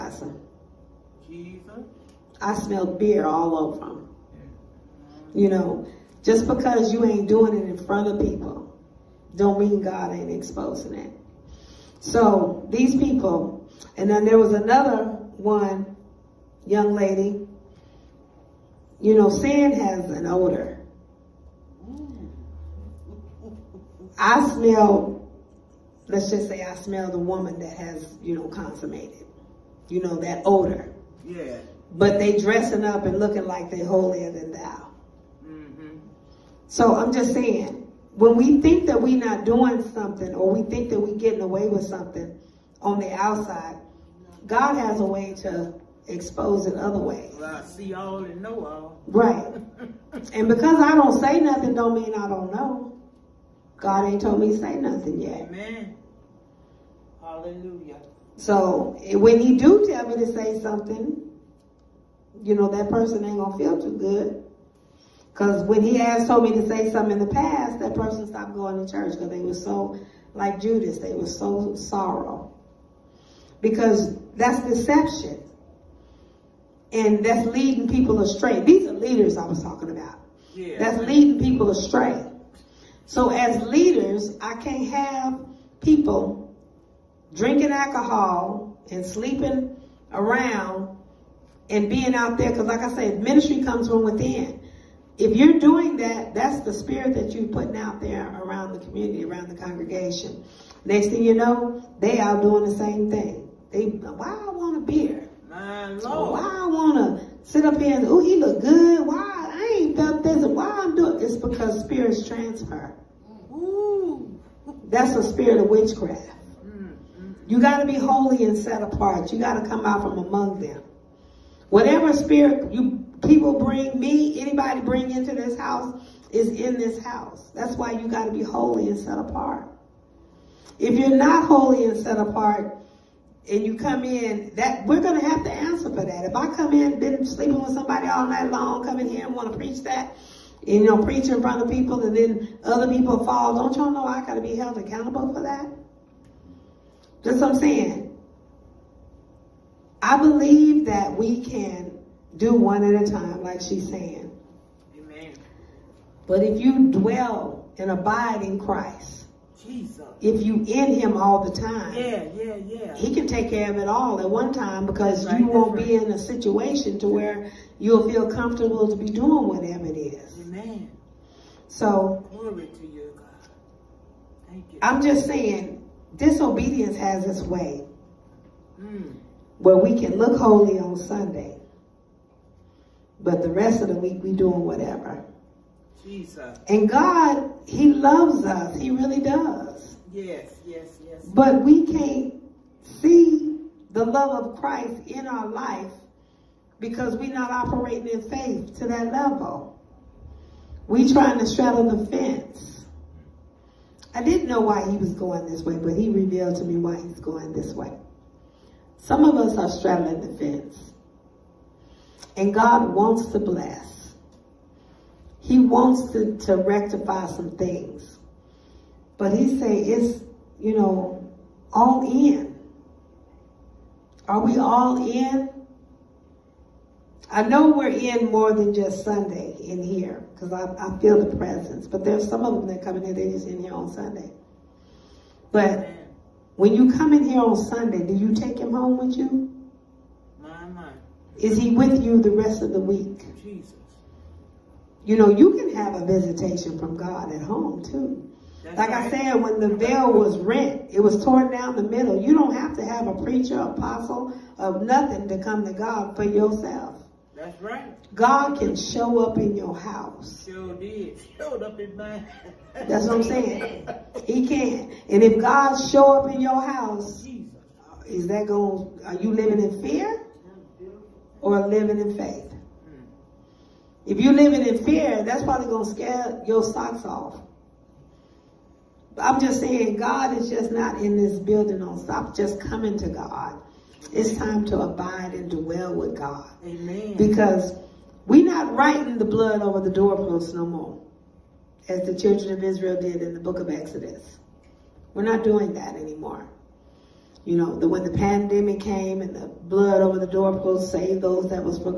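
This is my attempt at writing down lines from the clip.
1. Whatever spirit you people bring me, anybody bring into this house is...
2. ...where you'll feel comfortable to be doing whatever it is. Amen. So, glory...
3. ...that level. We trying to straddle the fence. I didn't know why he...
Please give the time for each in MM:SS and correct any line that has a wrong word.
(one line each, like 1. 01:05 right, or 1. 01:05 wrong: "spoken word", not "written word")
1. 02:01 right
2. 02:47 right
3. 03:18 right.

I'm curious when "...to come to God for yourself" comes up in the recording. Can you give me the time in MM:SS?
04:15.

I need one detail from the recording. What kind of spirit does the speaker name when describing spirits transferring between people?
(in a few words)
Witchcraft.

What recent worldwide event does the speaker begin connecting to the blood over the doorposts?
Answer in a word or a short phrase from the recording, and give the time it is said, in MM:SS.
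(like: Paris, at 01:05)
The pandemic, at 04:58.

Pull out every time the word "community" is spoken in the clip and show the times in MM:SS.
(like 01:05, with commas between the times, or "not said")
01:38.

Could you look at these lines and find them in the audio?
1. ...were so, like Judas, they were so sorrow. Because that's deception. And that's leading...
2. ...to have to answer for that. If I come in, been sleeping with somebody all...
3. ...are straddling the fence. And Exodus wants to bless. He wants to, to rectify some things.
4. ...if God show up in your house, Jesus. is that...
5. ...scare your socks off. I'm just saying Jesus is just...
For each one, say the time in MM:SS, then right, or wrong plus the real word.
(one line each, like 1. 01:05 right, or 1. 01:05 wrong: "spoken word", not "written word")
1. 01:09 right
2. 02:15 right
3. 03:29 wrong: "God", not "Exodus"
4. 04:25 right
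5. 04:35 wrong: "God", not "Jesus".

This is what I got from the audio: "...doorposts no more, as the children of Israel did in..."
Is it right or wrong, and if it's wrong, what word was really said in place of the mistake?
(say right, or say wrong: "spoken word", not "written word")
right.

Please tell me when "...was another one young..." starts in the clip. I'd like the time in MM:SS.
00:14.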